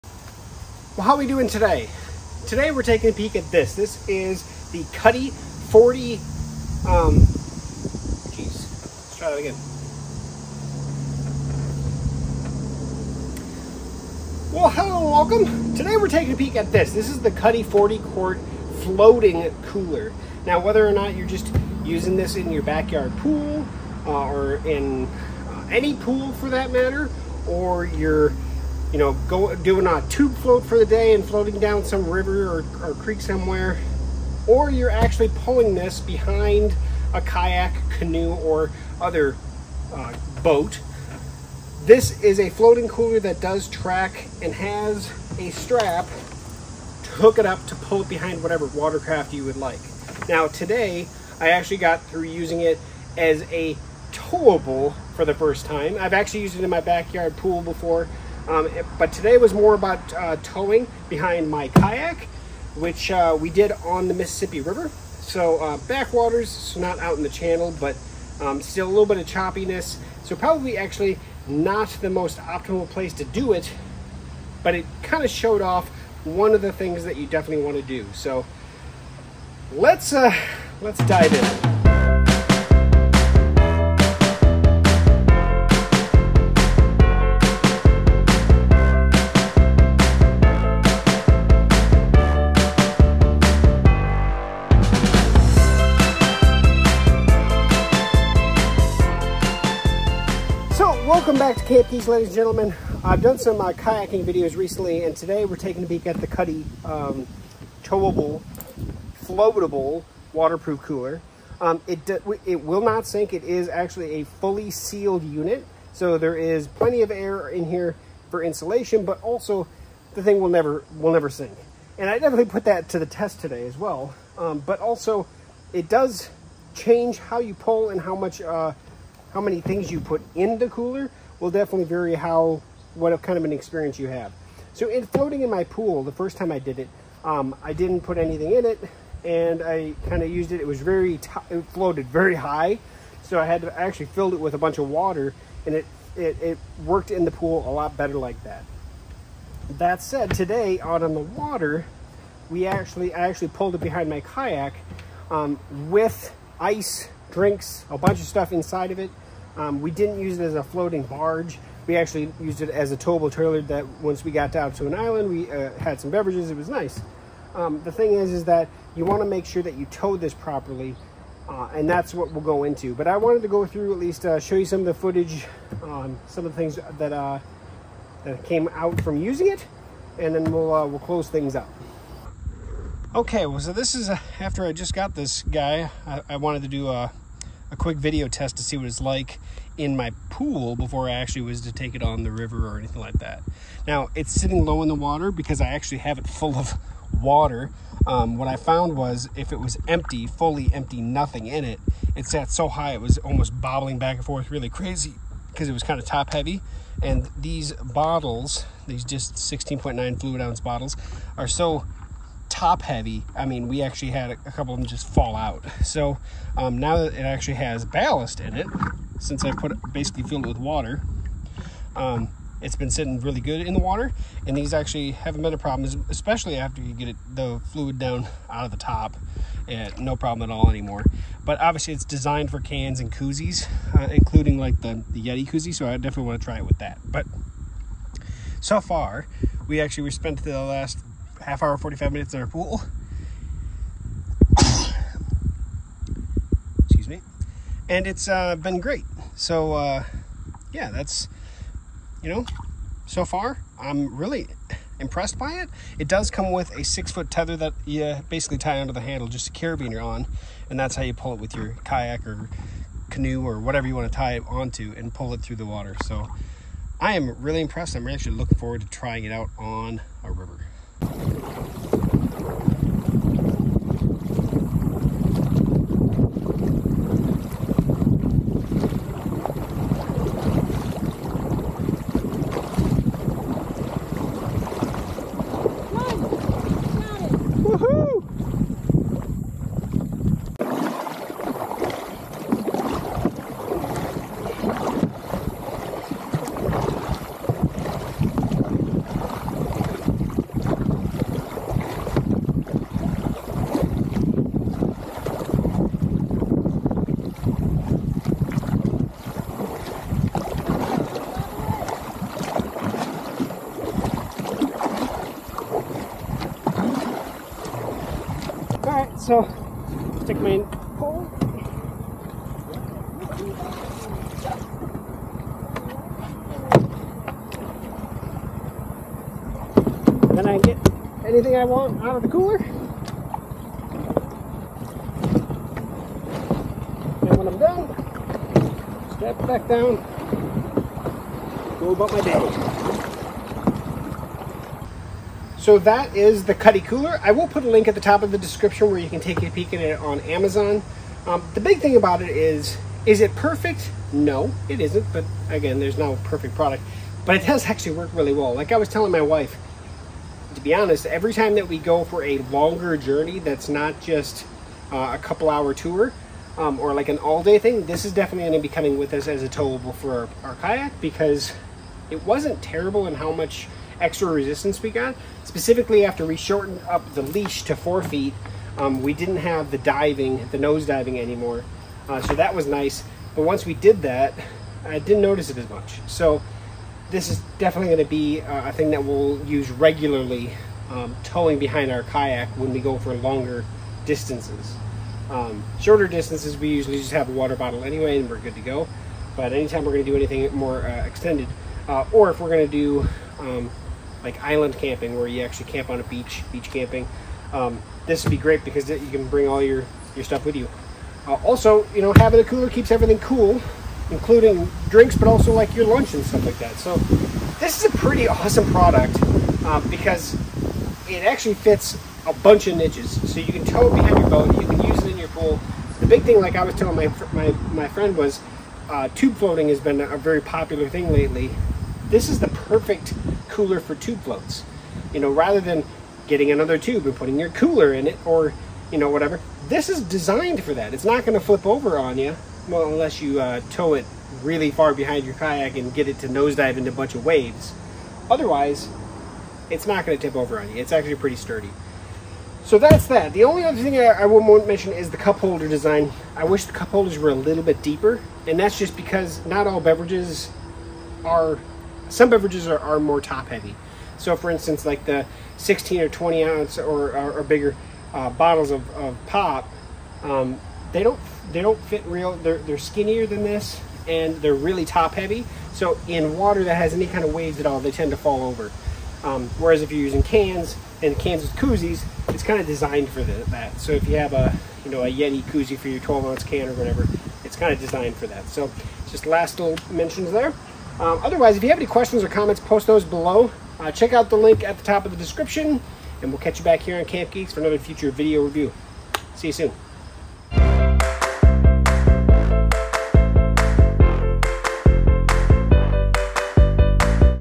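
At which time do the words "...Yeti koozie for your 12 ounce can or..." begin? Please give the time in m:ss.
8:05.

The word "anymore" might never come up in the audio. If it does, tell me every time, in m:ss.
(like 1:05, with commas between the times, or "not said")
3:50, 6:21.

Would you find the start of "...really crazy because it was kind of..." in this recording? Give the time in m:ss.
3:24.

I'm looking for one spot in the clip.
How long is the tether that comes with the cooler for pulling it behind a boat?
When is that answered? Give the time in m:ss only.
4:16.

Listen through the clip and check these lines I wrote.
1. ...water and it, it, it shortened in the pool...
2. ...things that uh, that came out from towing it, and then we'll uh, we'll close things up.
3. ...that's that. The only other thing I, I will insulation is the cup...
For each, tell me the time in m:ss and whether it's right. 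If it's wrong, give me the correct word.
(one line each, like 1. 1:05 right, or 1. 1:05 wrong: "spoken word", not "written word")
1. 2:24 wrong: "worked", not "shortened"
2. 2:56 wrong: "using", not "towing"
3. 7:32 wrong: "mention", not "insulation".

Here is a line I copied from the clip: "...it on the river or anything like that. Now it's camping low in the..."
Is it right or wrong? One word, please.
wrong.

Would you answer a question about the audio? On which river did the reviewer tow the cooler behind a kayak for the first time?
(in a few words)
Mississippi River.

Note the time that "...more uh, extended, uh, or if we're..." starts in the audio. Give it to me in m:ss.
6:40.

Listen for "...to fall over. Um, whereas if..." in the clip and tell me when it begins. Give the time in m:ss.
7:58.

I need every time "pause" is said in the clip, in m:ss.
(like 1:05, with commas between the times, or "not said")
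not said.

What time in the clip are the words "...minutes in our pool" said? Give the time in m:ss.
4:02.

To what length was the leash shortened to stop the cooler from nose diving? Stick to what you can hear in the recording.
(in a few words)
4 feet.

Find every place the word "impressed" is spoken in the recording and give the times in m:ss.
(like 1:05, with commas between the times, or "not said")
4:14, 4:27.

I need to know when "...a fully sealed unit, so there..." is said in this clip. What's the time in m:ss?
1:54.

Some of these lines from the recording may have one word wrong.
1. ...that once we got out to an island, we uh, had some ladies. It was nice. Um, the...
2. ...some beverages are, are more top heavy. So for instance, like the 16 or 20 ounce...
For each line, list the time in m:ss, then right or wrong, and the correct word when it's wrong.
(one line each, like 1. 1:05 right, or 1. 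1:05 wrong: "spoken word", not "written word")
1. 2:43 wrong: "beverages", not "ladies"
2. 7:42 right.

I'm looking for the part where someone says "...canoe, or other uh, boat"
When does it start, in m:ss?
0:37.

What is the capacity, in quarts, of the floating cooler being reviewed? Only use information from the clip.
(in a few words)
40.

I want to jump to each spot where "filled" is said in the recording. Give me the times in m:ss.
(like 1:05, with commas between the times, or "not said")
2:24, 3:40.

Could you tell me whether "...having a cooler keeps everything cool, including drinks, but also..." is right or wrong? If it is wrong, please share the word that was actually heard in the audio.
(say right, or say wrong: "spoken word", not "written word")
right.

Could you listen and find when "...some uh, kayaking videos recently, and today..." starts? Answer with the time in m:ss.
1:43.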